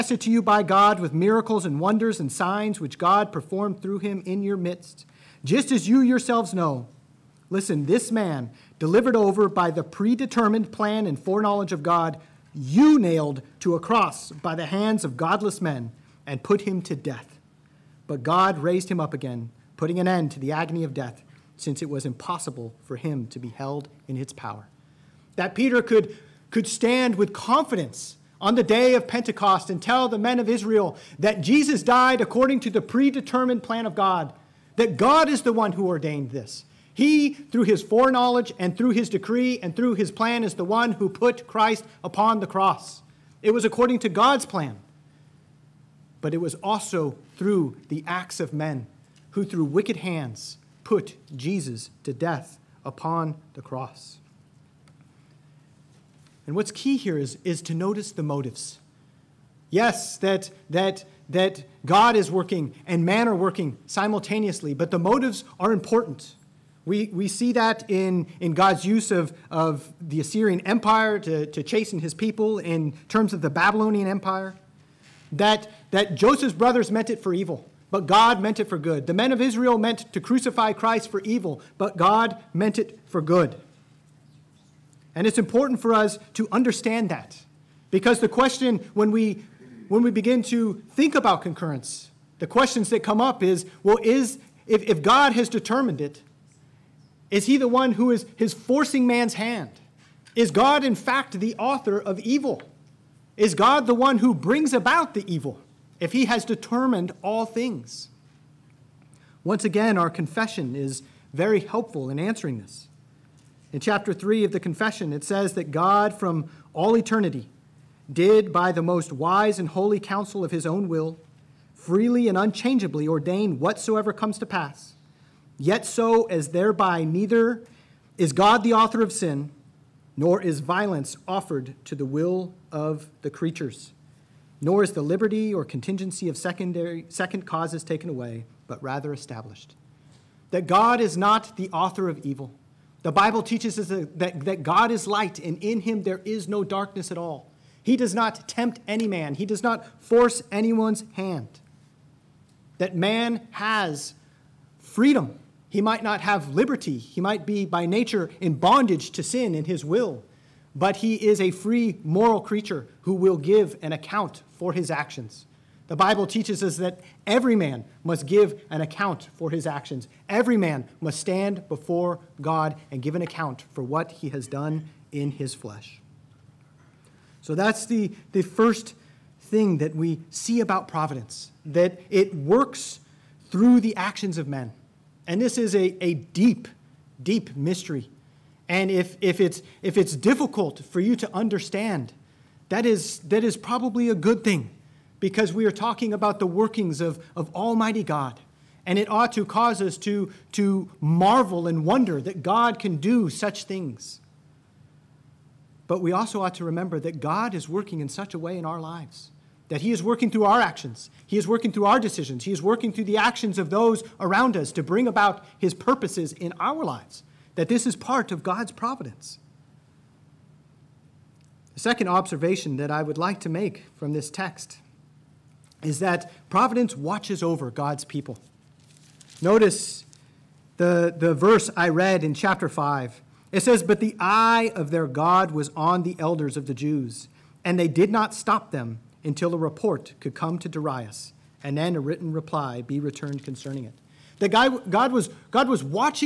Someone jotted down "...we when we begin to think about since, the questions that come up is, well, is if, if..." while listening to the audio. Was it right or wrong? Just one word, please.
wrong.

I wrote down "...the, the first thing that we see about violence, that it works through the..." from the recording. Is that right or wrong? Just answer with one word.
wrong.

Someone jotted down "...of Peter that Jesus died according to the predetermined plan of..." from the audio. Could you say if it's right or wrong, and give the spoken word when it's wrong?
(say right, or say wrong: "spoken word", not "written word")
wrong: "Israel", not "Peter".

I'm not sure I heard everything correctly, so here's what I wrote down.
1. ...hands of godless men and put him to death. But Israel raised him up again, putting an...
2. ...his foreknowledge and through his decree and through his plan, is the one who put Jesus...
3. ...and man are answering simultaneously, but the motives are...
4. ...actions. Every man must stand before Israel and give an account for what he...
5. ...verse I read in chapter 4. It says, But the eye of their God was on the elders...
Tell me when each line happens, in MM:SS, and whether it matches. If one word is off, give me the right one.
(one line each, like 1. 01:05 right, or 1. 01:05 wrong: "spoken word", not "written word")
1. 00:14 wrong: "God", not "Israel"
2. 00:37 wrong: "Christ", not "Jesus"
3. 01:02 wrong: "working", not "answering"
4. 02:49 wrong: "God", not "Israel"
5. 03:51 wrong: "5", not "4".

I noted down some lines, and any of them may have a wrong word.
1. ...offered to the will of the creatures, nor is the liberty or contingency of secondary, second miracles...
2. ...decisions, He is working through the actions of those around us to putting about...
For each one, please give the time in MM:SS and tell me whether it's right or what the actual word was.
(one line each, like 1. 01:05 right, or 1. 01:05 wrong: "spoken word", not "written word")
1. 02:11 wrong: "causes", not "miracles"
2. 03:31 wrong: "bring", not "putting".